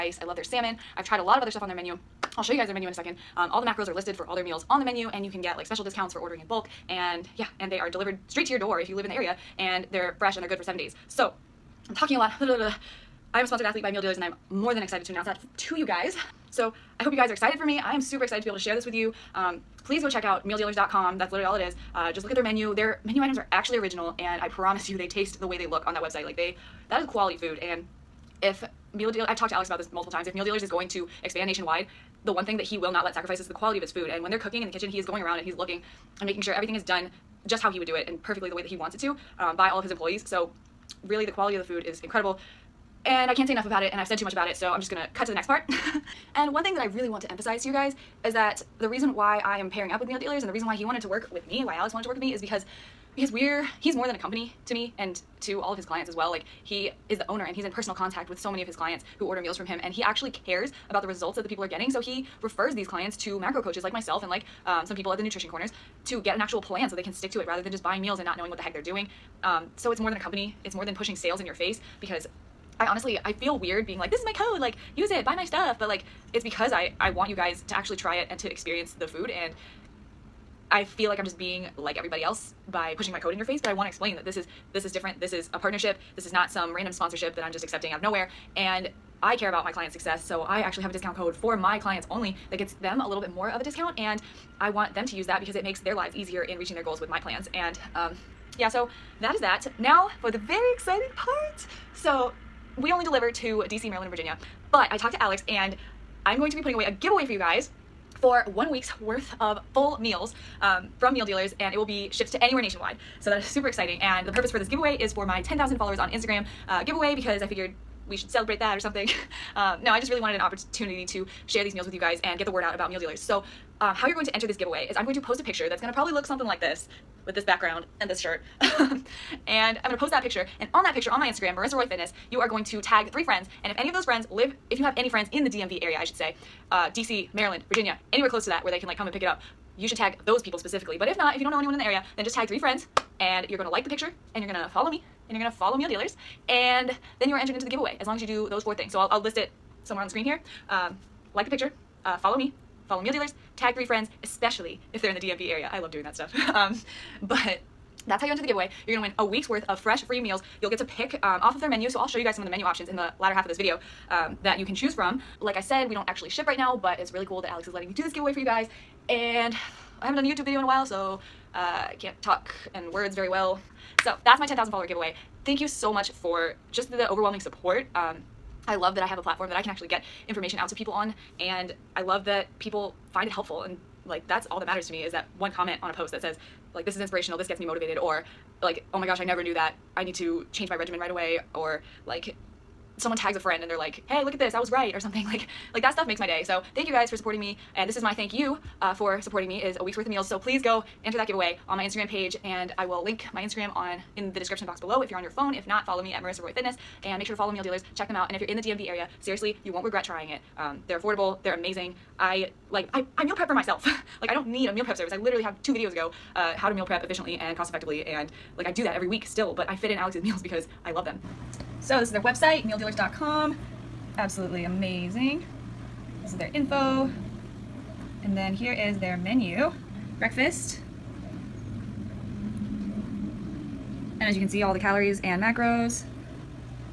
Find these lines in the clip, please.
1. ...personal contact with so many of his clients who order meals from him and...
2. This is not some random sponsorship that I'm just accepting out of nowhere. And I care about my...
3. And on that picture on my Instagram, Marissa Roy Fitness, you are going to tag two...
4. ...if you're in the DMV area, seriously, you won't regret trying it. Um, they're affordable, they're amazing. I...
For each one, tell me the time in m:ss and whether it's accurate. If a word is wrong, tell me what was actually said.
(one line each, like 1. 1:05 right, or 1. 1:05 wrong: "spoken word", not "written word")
1. 0:57 right
2. 1:26 right
3. 2:10 wrong: "three", not "two"
4. 3:28 right.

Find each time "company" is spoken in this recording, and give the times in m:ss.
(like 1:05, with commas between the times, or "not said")
0:54, 1:10.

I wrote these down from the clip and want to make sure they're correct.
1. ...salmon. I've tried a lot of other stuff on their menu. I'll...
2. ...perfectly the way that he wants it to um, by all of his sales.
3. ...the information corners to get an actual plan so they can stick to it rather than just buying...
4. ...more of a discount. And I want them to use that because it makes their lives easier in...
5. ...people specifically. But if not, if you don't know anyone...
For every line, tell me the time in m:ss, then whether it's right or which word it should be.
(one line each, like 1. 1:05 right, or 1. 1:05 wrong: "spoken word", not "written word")
1. 0:00 right
2. 0:38 wrong: "employees", not "sales"
3. 1:05 wrong: "nutrition", not "information"
4. 1:33 right
5. 2:20 right.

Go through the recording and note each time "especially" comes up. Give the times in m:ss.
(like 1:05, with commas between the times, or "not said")
2:34.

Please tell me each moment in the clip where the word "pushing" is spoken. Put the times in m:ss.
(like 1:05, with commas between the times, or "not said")
1:10, 1:22.